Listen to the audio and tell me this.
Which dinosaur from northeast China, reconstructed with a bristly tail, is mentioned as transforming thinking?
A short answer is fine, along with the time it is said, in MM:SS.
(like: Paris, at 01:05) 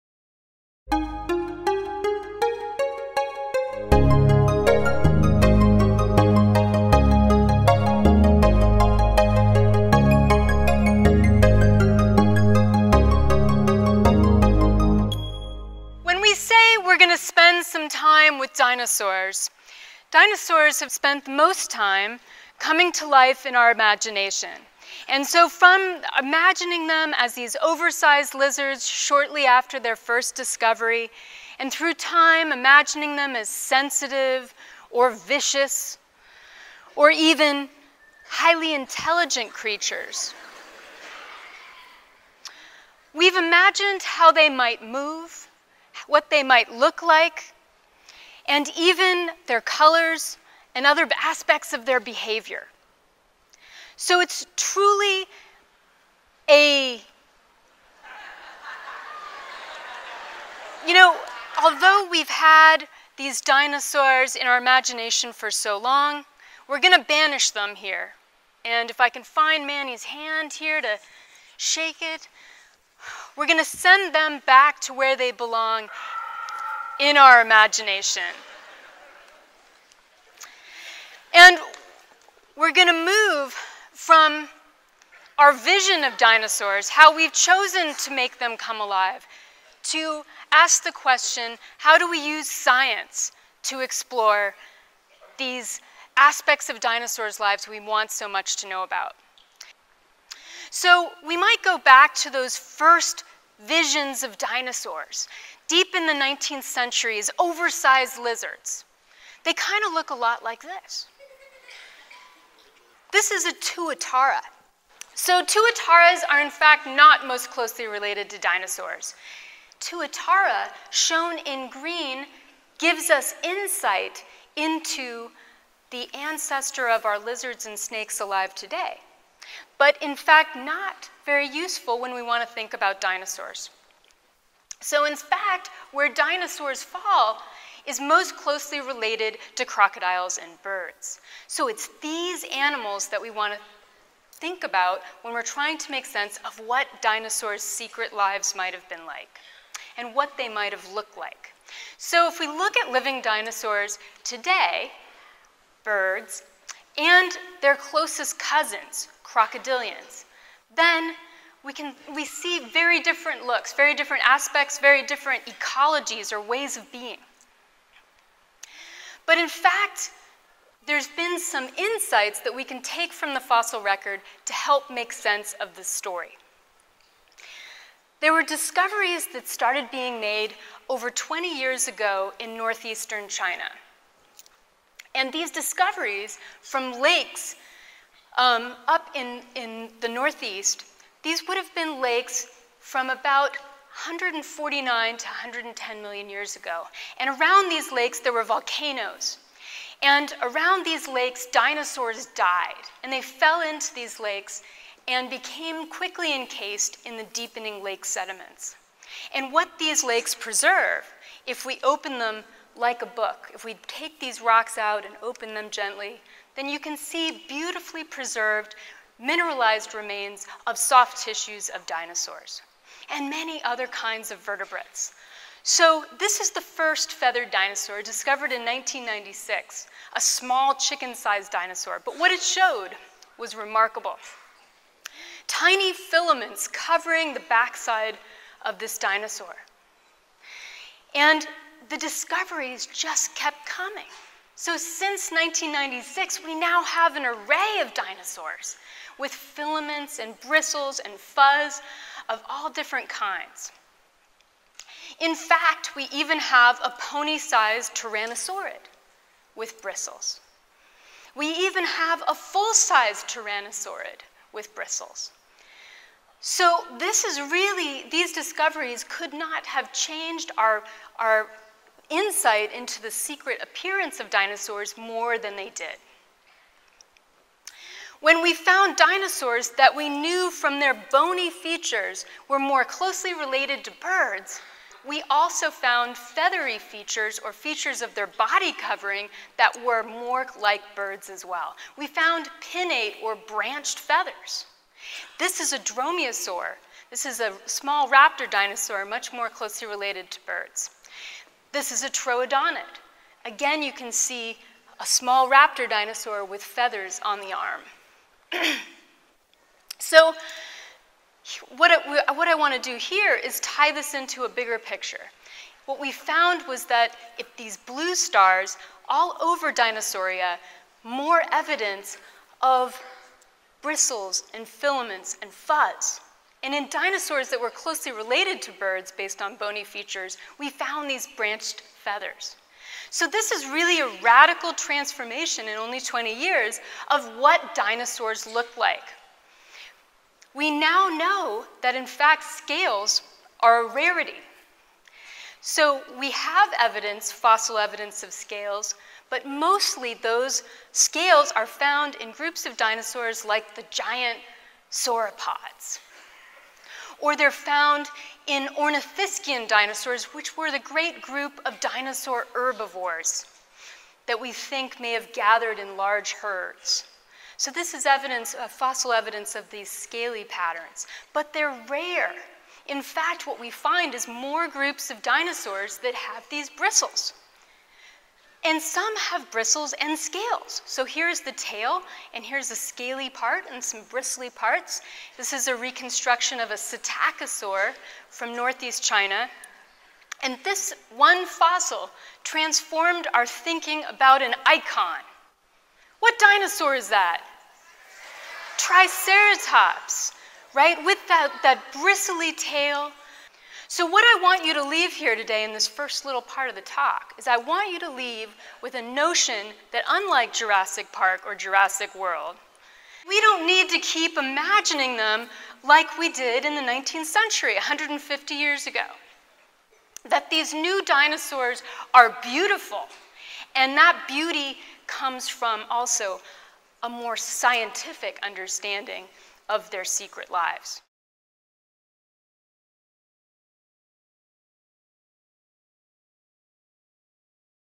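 psittacosaur, at 06:26.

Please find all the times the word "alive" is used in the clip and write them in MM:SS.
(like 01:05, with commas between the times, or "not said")
01:28, 02:08.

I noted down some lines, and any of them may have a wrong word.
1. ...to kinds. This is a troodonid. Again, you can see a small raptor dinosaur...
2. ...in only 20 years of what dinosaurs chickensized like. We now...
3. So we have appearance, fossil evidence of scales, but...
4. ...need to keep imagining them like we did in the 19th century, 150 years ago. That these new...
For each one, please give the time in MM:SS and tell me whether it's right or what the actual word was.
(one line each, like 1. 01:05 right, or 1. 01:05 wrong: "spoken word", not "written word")
1. 05:00 wrong: "birds", not "kinds"
2. 05:35 wrong: "looked", not "chickensized"
3. 05:45 wrong: "evidence", not "appearance"
4. 06:53 right.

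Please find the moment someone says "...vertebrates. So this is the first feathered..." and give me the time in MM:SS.
03:44.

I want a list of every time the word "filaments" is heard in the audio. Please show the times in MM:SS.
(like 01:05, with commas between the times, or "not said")
03:55, 04:09, 05:24.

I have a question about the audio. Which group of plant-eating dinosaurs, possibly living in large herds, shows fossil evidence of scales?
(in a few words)
ornithischian dinosaurs.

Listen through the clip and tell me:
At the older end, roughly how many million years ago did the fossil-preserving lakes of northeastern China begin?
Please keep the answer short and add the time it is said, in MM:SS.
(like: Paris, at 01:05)
149, at 03:13.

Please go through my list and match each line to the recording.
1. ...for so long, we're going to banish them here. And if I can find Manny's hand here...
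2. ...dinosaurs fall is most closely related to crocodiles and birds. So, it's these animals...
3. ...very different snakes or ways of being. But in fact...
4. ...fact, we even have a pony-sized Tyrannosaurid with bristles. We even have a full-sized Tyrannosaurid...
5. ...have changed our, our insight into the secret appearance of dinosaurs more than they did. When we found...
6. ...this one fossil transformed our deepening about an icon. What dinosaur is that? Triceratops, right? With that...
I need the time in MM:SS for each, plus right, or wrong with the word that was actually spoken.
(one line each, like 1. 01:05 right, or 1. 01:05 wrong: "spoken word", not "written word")
1. 01:05 right
2. 02:16 right
3. 02:44 wrong: "ecologies", not "snakes"
4. 04:15 right
5. 04:29 right
6. 06:30 wrong: "thinking", not "deepening".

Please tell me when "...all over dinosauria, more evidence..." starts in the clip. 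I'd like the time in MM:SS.
05:19.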